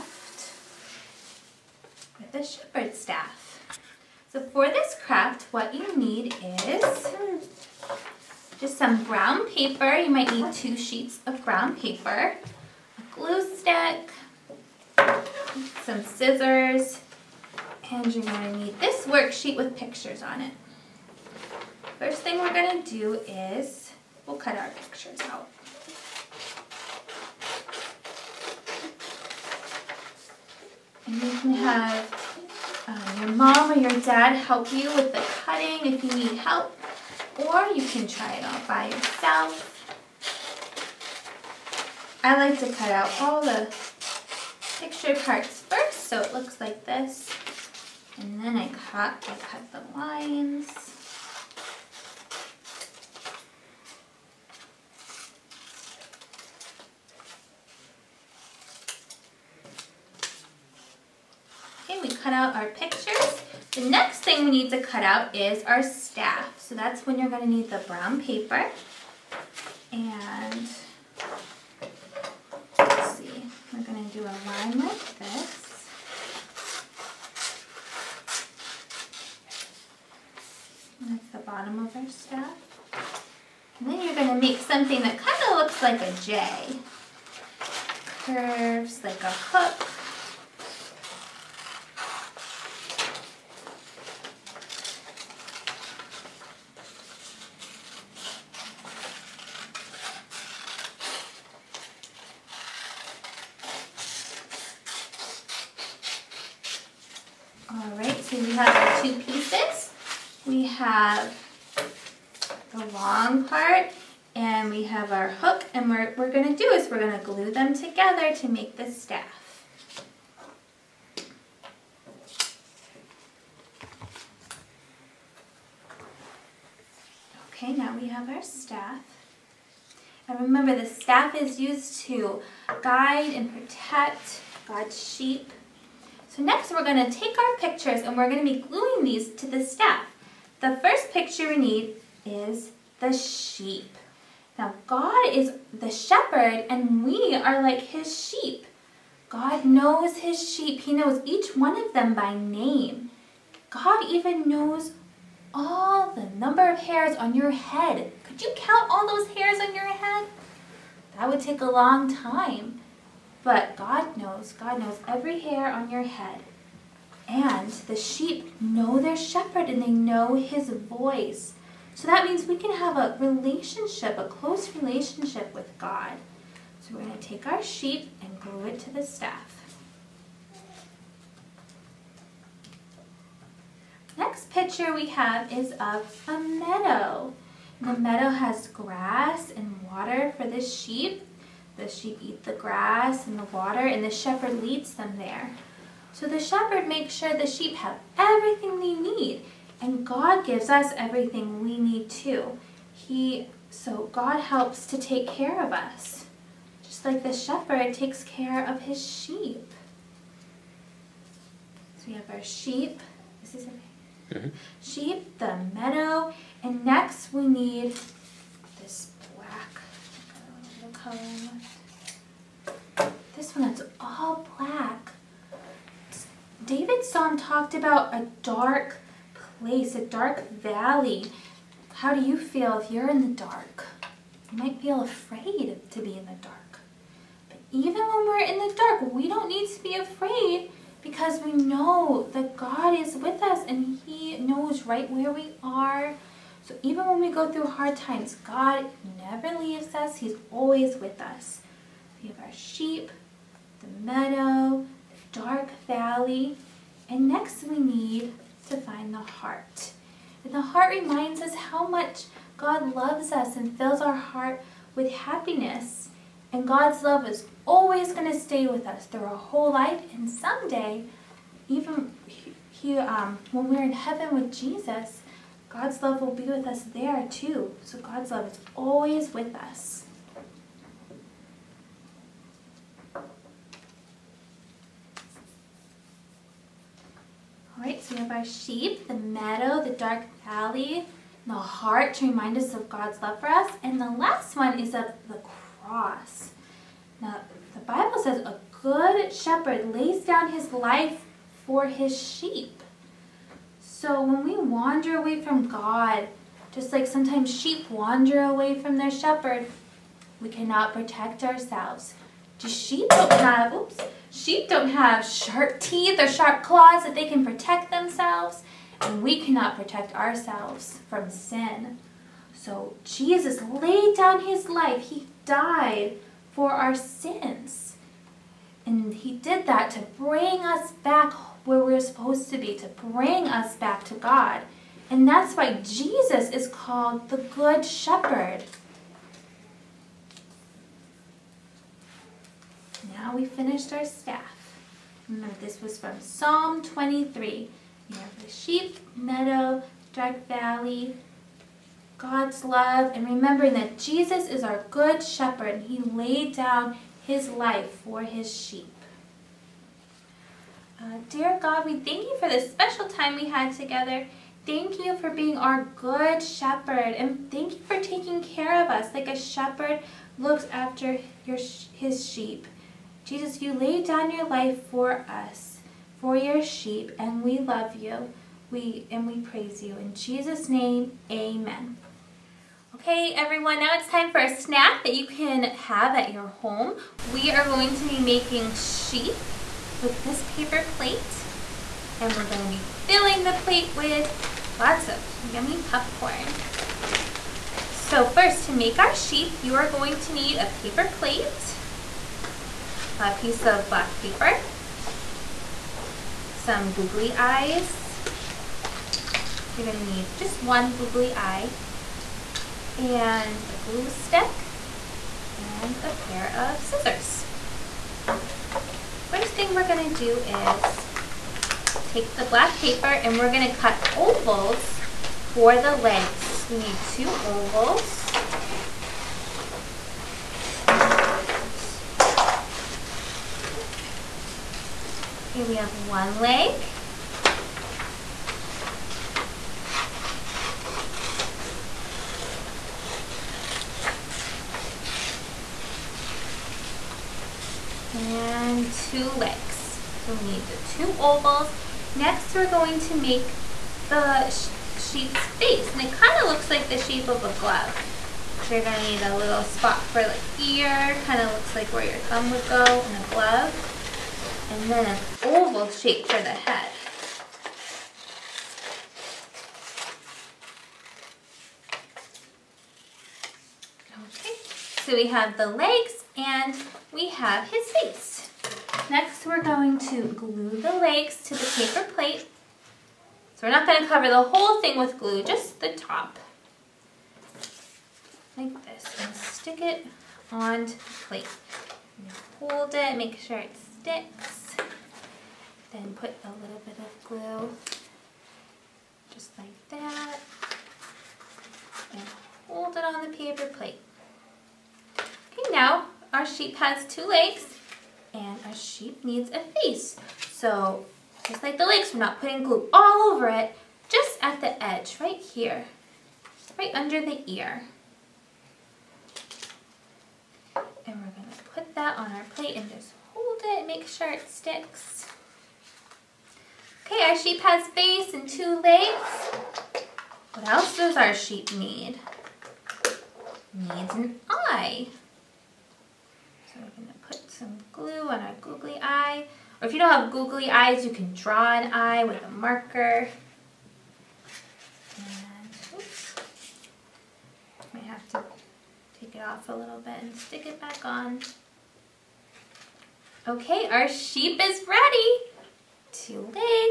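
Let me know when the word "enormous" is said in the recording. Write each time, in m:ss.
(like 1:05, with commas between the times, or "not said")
not said.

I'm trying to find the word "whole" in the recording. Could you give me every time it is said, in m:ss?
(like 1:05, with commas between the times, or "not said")
4:29, 8:04.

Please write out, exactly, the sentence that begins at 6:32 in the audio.
And we're gonna be filling the plate with lots of yummy popcorn.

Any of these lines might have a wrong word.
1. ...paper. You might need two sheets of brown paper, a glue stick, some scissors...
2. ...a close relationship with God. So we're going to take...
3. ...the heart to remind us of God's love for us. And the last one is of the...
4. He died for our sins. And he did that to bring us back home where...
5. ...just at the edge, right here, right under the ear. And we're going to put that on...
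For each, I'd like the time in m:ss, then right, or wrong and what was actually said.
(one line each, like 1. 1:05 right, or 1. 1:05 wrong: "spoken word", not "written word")
1. 0:09 right
2. 2:54 right
3. 4:51 right
4. 5:25 right
5. 8:34 right.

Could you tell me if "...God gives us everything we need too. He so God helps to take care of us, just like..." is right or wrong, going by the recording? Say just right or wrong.
right.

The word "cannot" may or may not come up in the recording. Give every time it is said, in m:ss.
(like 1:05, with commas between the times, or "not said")
5:10, 5:19.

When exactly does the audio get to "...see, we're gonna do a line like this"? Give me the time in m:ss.
1:13.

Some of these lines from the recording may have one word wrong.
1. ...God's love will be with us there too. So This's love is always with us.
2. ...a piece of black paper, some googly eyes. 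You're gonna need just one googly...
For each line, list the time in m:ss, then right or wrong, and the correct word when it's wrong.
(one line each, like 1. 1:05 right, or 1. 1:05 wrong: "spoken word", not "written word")
1. 4:35 wrong: "God", not "This"
2. 6:43 right.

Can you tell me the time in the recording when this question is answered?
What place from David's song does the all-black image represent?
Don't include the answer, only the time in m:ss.
3:49.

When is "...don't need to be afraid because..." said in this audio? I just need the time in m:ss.
3:59.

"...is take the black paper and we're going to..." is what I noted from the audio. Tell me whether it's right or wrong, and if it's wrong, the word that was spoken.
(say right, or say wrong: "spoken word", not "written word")
right.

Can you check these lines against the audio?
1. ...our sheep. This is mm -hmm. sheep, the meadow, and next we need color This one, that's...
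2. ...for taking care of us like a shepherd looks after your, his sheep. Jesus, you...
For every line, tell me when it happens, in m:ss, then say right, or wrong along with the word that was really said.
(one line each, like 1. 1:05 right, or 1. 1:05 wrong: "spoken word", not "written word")
1. 3:32 right
2. 6:07 right.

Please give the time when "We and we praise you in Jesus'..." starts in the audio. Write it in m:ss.
6:18.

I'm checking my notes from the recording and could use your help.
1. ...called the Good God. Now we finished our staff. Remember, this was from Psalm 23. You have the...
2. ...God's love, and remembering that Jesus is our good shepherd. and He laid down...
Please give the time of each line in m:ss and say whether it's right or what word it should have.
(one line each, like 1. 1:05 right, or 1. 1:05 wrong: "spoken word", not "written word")
1. 5:36 wrong: "Shepherd", not "God"
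2. 5:52 right.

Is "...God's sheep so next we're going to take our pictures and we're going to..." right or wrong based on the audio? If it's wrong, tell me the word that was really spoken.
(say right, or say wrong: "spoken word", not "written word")
right.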